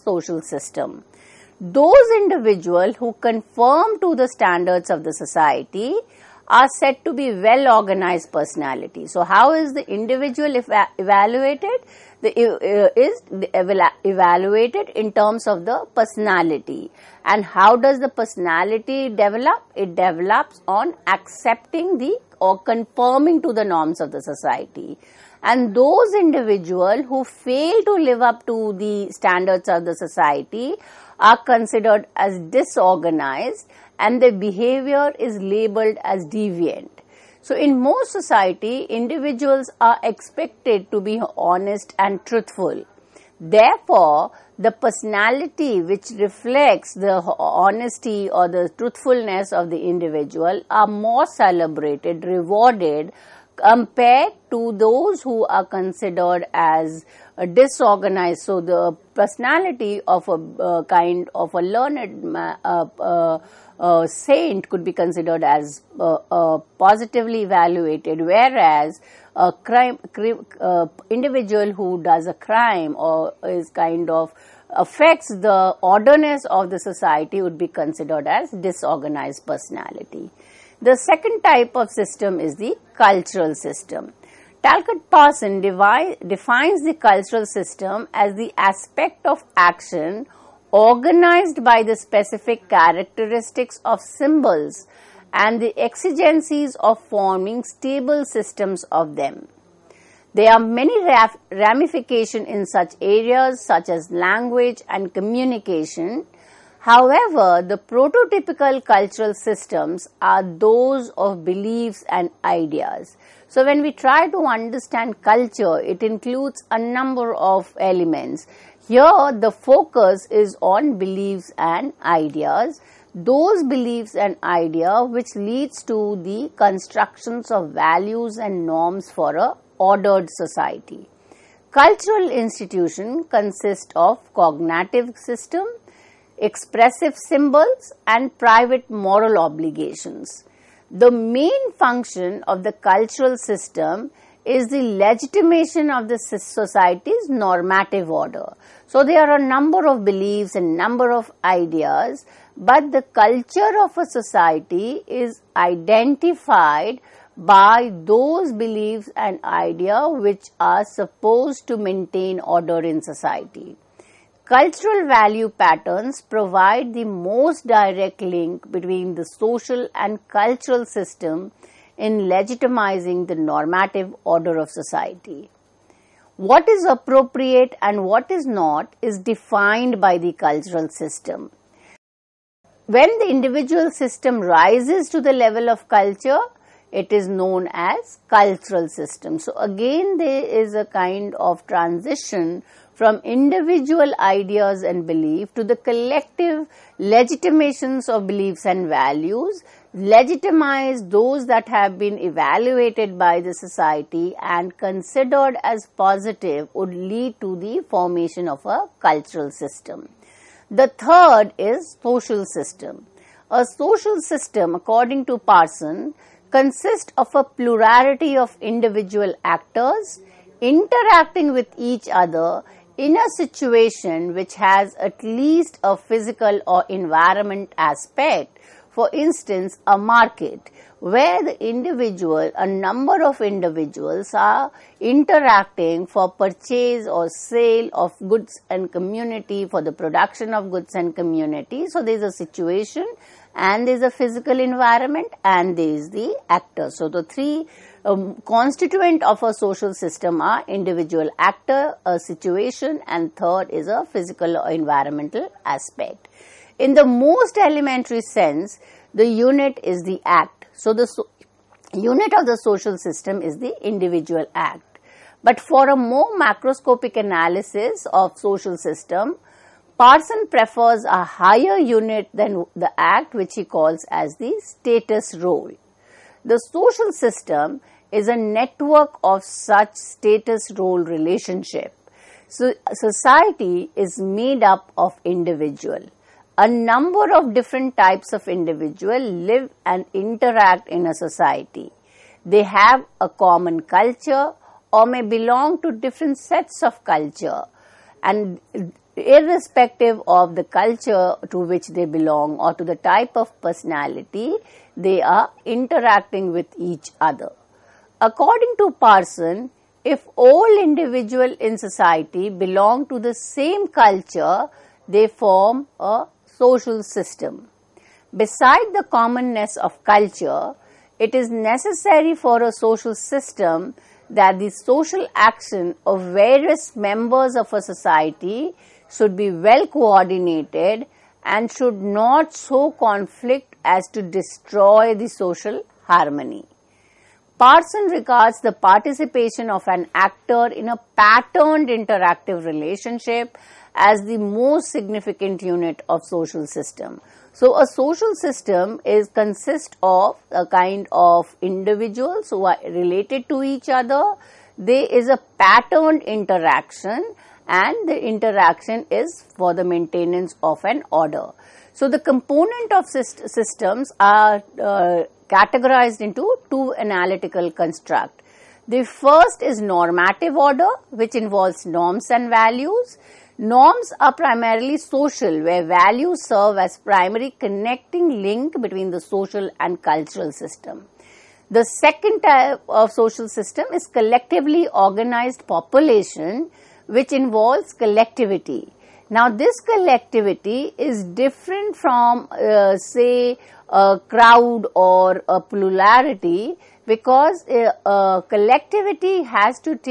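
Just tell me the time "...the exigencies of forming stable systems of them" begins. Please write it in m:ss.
1:35.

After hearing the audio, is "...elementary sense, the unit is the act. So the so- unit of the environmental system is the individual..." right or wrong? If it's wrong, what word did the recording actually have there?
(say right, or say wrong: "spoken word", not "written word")
wrong: "social", not "environmental".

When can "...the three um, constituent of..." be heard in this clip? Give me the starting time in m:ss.
4:07.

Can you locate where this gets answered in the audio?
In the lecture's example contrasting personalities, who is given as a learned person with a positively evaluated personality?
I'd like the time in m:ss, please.
1:04.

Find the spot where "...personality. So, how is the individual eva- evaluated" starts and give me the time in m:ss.
0:08.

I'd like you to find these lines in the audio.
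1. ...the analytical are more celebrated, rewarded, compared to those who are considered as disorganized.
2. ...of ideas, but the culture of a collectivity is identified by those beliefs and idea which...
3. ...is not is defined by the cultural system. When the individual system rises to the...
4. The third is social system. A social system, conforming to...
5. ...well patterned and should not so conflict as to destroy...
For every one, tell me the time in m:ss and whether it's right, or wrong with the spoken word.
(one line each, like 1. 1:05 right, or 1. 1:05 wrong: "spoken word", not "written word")
1. 0:49 wrong: "individual", not "analytical"
2. 2:31 wrong: "society", not "collectivity"
3. 2:58 right
4. 3:30 wrong: "according", not "conforming"
5. 5:29 wrong: "coordinated", not "patterned".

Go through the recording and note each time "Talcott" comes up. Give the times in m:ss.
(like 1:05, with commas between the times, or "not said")
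1:24.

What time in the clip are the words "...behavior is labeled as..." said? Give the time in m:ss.
0:34.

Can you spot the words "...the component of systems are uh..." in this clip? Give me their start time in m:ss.
6:02.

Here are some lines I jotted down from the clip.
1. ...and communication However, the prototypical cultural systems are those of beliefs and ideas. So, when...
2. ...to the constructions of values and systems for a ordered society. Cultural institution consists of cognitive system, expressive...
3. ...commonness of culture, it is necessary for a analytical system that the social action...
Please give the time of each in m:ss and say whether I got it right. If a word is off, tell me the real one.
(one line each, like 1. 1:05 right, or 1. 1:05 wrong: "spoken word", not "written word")
1. 1:44 right
2. 2:05 wrong: "norms", not "systems"
3. 5:19 wrong: "social", not "analytical".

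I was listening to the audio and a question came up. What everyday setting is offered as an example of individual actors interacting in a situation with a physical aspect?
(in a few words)
a market.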